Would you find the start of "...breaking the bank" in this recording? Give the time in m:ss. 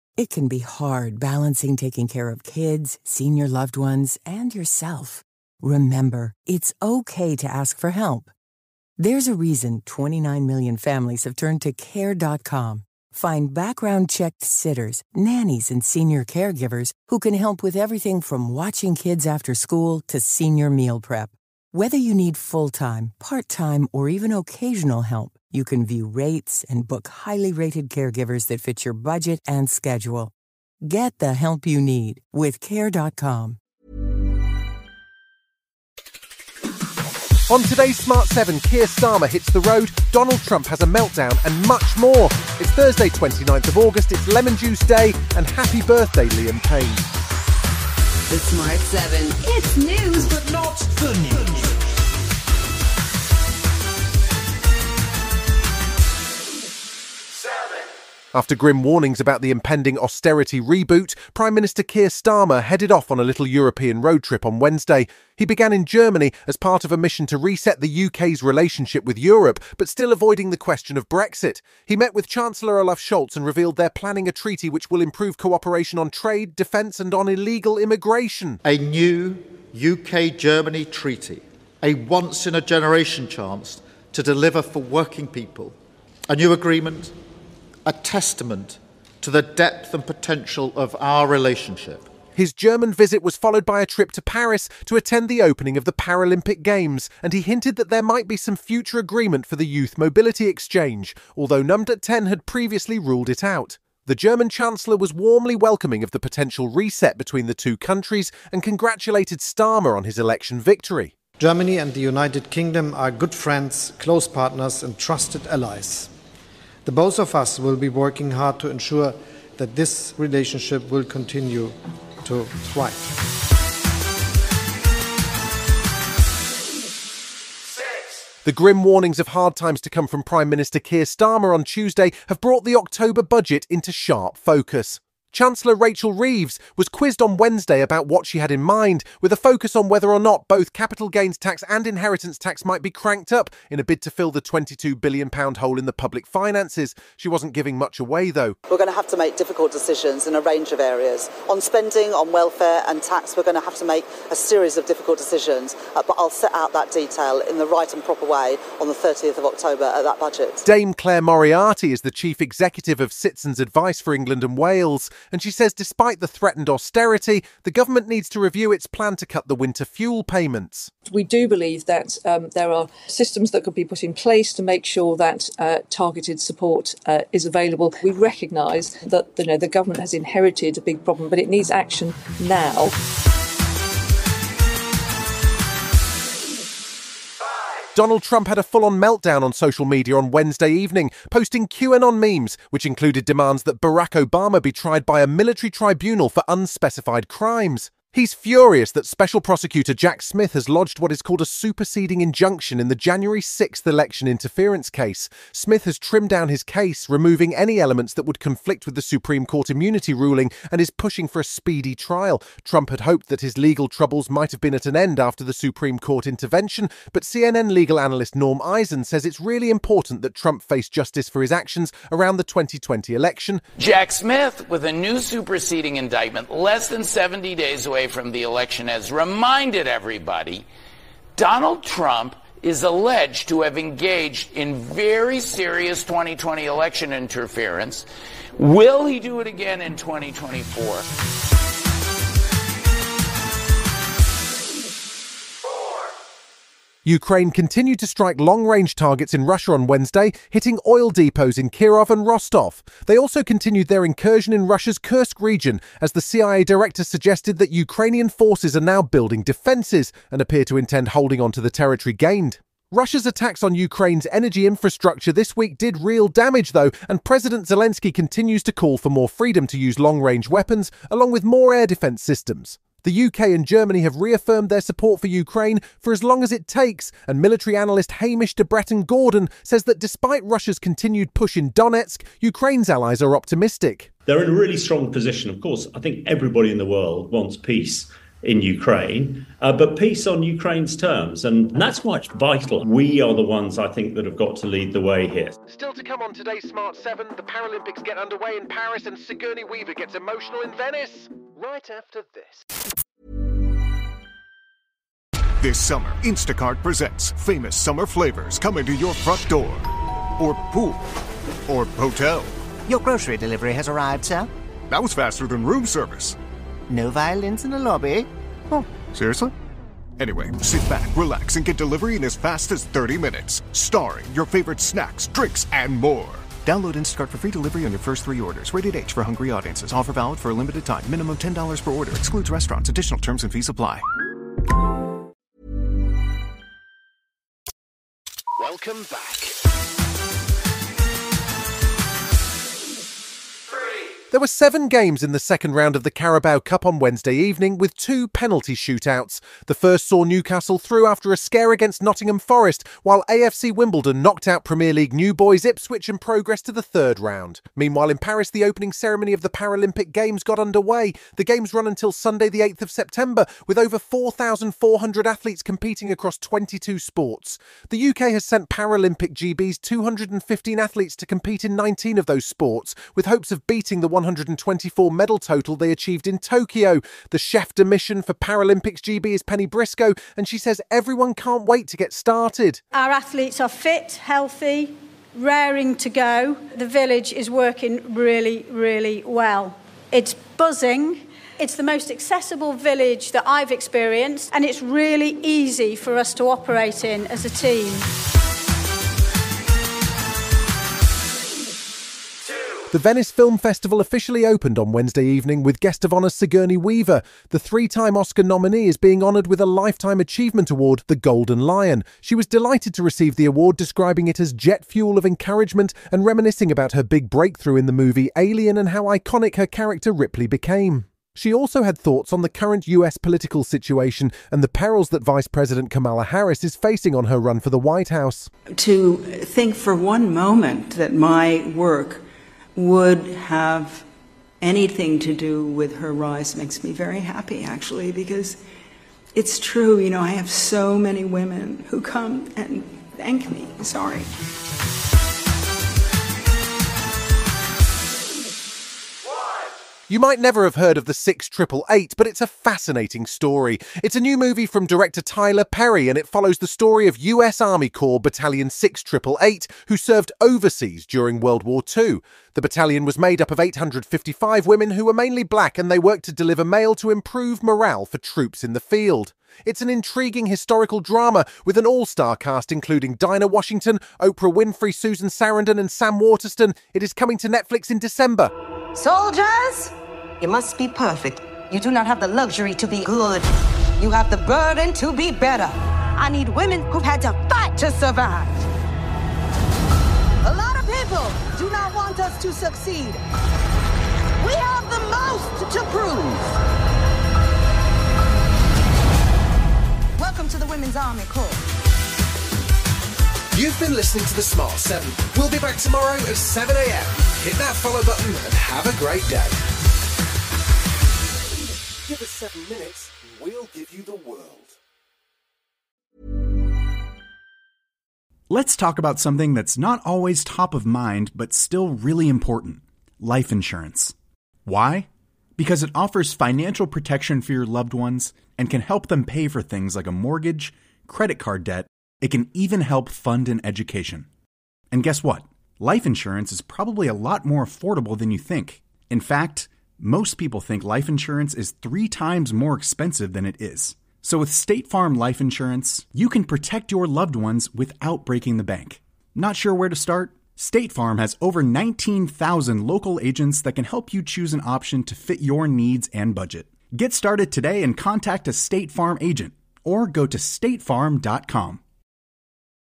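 9:08.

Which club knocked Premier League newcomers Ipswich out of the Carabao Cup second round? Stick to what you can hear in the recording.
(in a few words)
AFC Wimbledon.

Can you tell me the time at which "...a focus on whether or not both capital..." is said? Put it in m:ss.
2:19.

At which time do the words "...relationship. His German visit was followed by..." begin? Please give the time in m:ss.
1:31.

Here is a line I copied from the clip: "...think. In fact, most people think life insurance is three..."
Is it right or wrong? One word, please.
right.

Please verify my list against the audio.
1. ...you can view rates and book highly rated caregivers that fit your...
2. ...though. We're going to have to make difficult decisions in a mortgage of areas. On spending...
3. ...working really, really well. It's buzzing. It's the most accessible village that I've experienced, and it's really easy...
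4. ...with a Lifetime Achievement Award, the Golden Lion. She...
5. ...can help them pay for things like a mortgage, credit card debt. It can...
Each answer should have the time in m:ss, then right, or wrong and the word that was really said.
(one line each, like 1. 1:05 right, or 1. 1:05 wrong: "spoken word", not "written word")
1. 0:25 right
2. 2:28 wrong: "range", not "mortgage"
3. 6:27 right
4. 6:49 right
5. 8:48 right.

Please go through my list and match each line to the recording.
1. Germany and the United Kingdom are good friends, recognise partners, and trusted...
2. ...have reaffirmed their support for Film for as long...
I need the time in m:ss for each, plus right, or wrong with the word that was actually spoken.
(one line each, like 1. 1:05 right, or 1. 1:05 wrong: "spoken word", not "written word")
1. 1:51 wrong: "close", not "recognise"
2. 4:34 wrong: "Ukraine", not "Film".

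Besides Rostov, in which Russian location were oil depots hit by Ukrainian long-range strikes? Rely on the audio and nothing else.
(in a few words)
Kirov.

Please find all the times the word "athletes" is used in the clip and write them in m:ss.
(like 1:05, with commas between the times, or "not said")
6:05, 6:10, 6:23.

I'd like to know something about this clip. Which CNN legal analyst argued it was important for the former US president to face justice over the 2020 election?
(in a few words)
Norm Eisen.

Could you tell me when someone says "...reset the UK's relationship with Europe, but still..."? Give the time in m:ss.
1:07.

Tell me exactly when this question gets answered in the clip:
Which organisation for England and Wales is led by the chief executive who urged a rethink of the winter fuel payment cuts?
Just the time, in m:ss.
2:43.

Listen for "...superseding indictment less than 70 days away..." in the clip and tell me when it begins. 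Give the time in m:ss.
3:45.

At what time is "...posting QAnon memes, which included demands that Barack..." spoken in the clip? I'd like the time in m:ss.
3:11.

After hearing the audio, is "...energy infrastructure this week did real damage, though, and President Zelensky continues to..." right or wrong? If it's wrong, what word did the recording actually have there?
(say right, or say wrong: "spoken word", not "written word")
right.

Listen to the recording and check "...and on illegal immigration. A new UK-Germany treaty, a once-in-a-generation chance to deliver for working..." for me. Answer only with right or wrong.
right.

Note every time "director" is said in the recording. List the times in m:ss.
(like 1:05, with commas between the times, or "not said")
4:16, 7:34.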